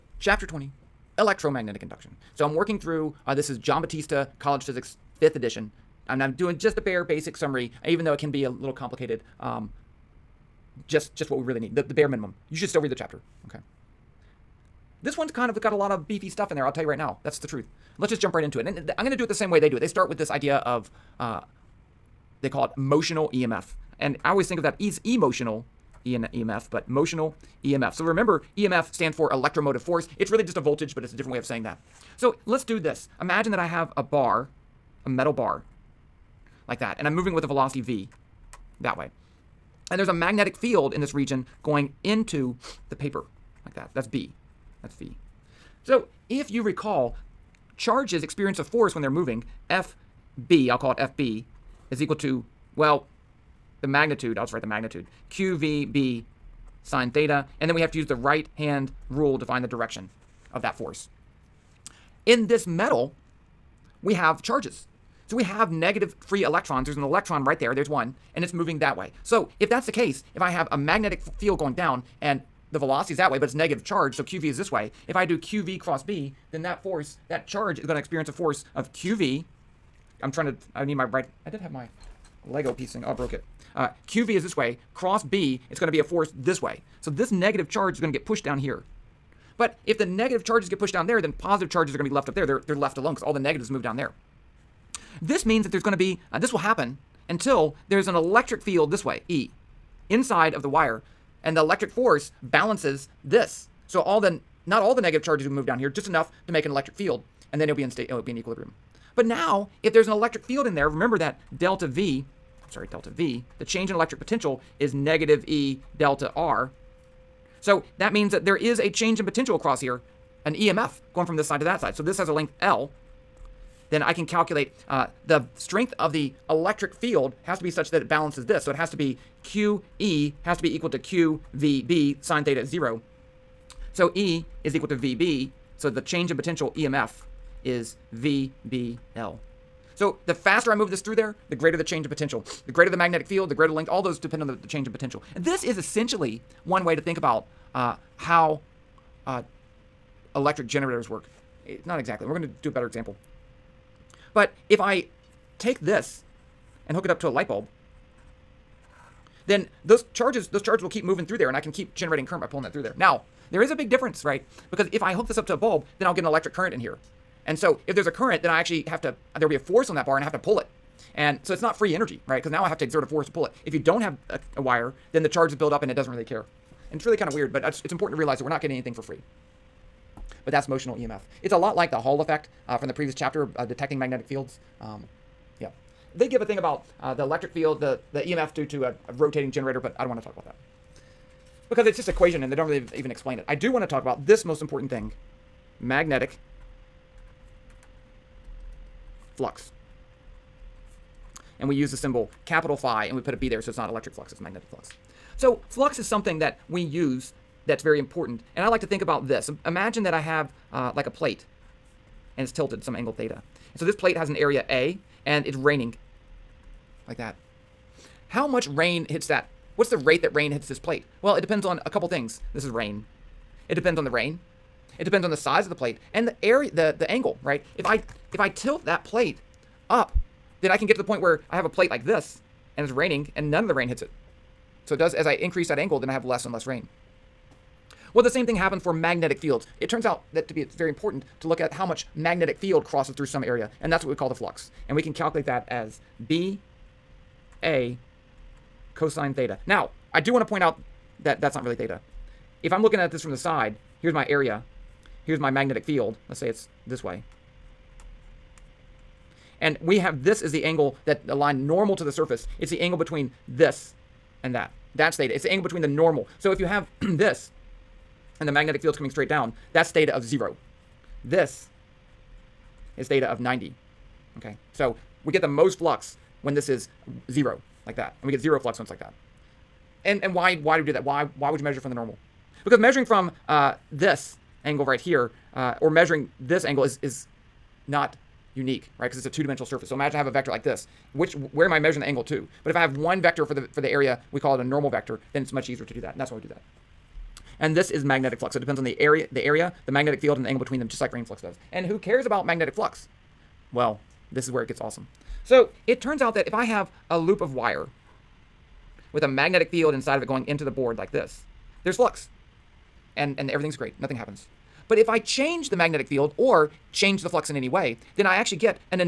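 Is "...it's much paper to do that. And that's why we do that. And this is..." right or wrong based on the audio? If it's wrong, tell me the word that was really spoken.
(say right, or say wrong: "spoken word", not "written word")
wrong: "easier", not "paper".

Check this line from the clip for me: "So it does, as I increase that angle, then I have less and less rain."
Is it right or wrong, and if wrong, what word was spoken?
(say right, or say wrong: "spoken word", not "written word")
right.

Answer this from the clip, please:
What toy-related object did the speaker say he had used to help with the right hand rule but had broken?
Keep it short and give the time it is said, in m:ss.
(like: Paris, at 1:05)
Lego piece, at 1:22.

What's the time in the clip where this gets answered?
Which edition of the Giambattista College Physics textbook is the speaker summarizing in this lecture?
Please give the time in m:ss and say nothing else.
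0:05.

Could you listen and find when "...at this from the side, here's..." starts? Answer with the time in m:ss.
4:12.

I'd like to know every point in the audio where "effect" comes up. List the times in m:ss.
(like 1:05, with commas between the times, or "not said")
3:02.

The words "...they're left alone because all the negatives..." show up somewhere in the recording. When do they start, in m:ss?
1:32.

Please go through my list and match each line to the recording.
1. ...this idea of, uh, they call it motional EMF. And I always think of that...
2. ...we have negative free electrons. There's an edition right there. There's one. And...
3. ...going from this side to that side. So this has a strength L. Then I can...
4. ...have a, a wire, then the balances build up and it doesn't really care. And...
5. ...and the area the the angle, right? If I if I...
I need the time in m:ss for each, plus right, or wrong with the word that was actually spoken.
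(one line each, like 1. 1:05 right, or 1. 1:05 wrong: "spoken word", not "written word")
1. 0:20 right
2. 1:05 wrong: "electron", not "edition"
3. 2:01 wrong: "length", not "strength"
4. 2:54 wrong: "charges", not "balances"
5. 3:46 right.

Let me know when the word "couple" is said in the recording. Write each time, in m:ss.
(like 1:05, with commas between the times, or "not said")
3:41.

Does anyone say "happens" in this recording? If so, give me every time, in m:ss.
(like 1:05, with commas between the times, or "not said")
1:36, 3:58, 5:14.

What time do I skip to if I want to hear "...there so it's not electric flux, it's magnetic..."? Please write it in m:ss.
3:23.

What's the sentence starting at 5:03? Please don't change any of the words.
Well, this is where it gets awesome.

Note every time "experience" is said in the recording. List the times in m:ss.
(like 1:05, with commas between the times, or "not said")
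0:48, 1:17.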